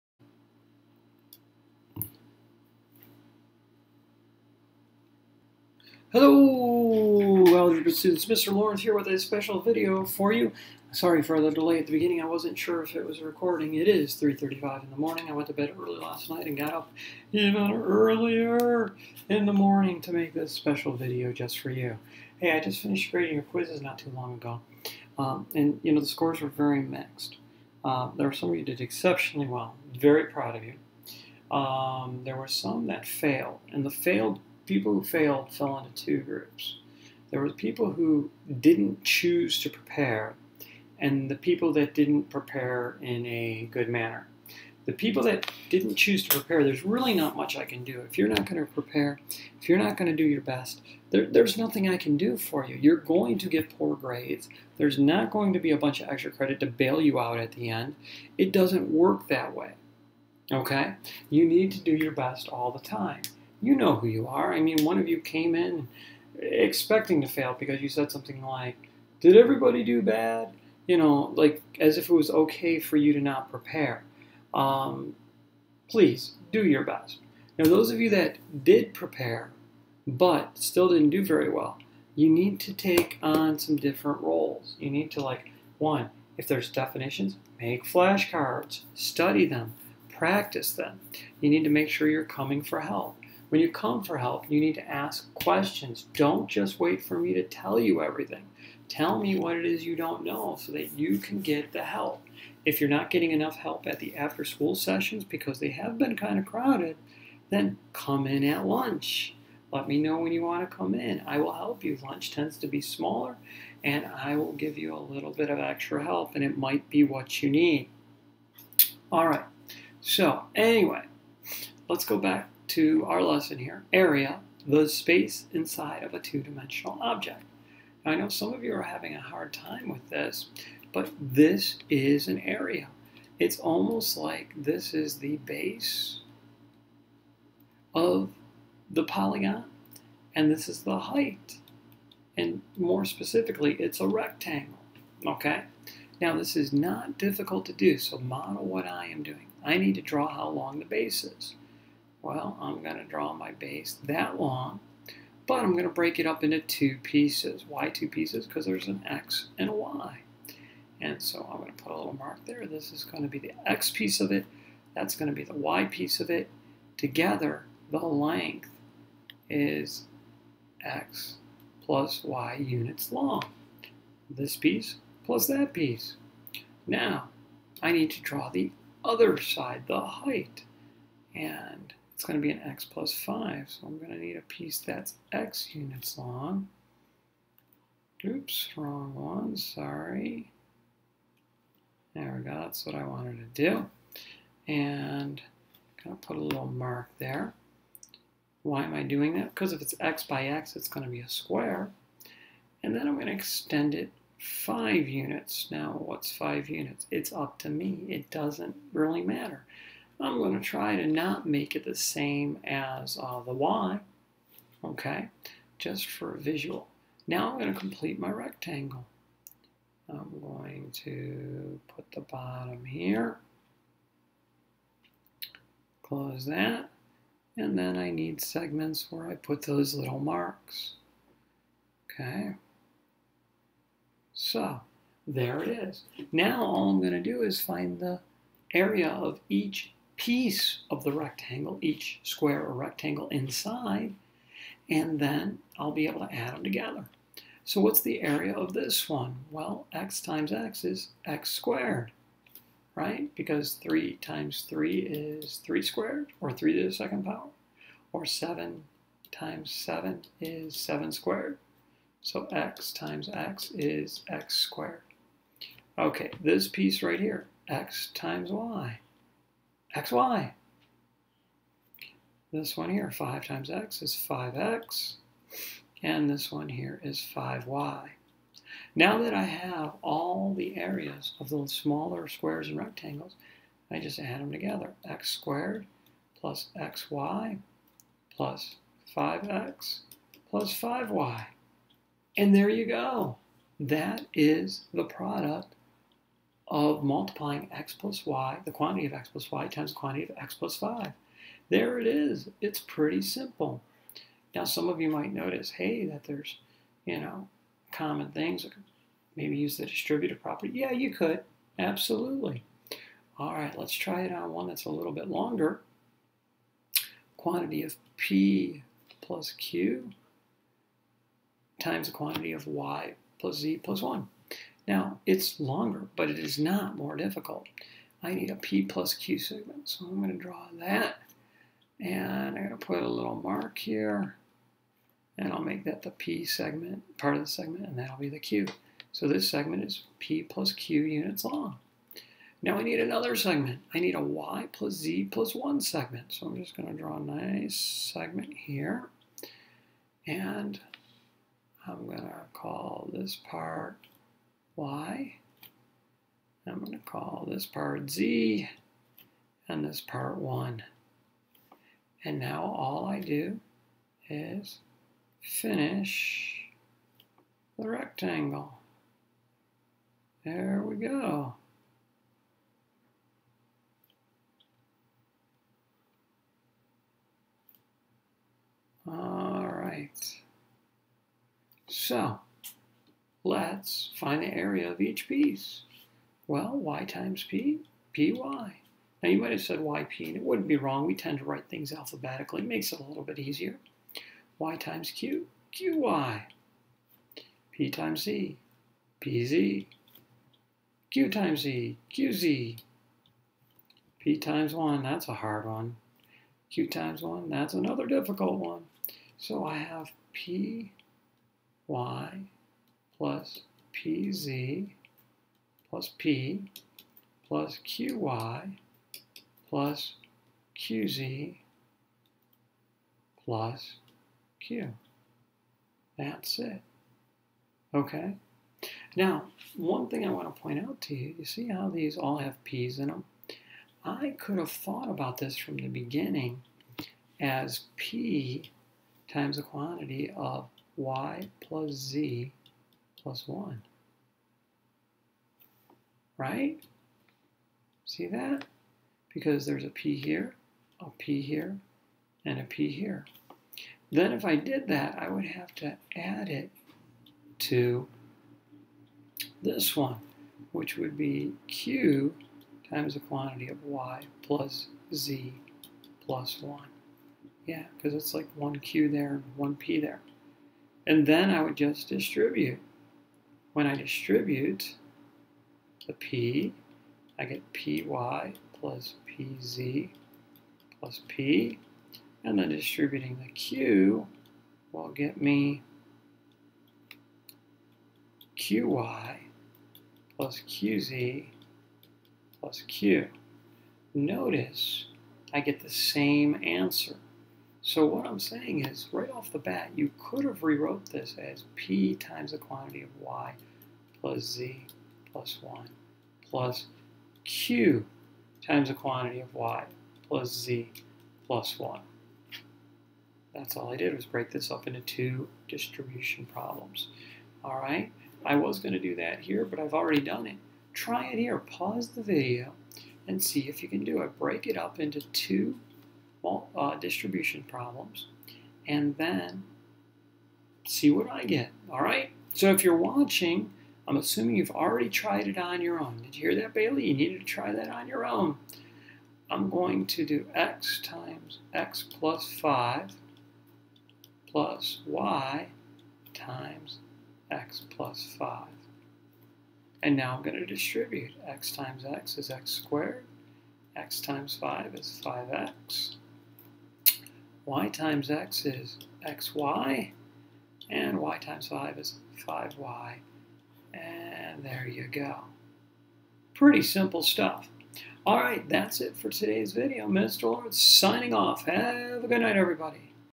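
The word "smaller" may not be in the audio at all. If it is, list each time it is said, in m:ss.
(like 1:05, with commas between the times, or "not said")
1:52, 4:41.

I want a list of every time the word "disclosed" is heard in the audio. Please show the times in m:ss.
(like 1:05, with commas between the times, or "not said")
not said.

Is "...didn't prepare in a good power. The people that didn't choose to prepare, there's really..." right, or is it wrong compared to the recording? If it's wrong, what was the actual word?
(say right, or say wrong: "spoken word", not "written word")
wrong: "manner", not "power".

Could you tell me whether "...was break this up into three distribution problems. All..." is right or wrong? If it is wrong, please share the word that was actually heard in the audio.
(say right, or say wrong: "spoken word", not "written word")
wrong: "two", not "three".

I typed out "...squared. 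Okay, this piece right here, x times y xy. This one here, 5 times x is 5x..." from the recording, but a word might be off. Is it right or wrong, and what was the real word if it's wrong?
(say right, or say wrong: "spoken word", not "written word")
right.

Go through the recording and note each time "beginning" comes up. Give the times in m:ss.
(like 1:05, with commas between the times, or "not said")
0:11, 7:15.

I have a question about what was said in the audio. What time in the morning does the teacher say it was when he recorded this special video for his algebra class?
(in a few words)
3:35.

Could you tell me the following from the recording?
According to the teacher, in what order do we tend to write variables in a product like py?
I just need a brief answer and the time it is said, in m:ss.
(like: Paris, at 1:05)
alphabetically, at 6:31.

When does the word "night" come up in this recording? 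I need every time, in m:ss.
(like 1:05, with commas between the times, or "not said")
0:16, 9:32.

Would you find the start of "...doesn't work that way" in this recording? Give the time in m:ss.
0:58.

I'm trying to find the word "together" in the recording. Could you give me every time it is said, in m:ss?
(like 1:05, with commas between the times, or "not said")
2:46, 4:06, 4:44.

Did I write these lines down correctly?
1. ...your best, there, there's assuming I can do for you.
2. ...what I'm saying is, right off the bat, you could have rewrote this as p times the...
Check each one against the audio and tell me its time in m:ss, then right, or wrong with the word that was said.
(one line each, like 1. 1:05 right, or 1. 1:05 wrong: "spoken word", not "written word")
1. 0:50 wrong: "nothing", not "assuming"
2. 8:18 right.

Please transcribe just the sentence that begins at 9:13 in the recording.
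x times 5 is 5x y times x is xy, and y times 5 is 5y, and there you go.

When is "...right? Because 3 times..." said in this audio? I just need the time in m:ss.
4:12.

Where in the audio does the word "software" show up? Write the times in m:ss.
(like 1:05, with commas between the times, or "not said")
not said.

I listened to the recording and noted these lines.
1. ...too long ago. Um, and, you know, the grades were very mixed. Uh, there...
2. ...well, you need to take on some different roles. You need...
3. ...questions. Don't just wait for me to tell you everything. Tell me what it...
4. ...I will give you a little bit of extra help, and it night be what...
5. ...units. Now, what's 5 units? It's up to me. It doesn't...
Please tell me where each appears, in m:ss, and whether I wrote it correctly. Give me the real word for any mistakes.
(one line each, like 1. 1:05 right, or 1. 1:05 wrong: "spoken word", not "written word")
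1. 0:23 wrong: "scores", not "grades"
2. 1:21 right
3. 1:35 right
4. 1:54 wrong: "might", not "night"
5. 3:25 right.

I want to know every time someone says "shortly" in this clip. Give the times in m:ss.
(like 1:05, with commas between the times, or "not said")
not said.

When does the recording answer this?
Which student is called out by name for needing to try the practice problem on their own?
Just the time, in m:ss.
8:56.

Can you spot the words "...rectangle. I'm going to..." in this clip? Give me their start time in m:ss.
3:38.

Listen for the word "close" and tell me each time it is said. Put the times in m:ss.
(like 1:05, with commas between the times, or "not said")
3:46.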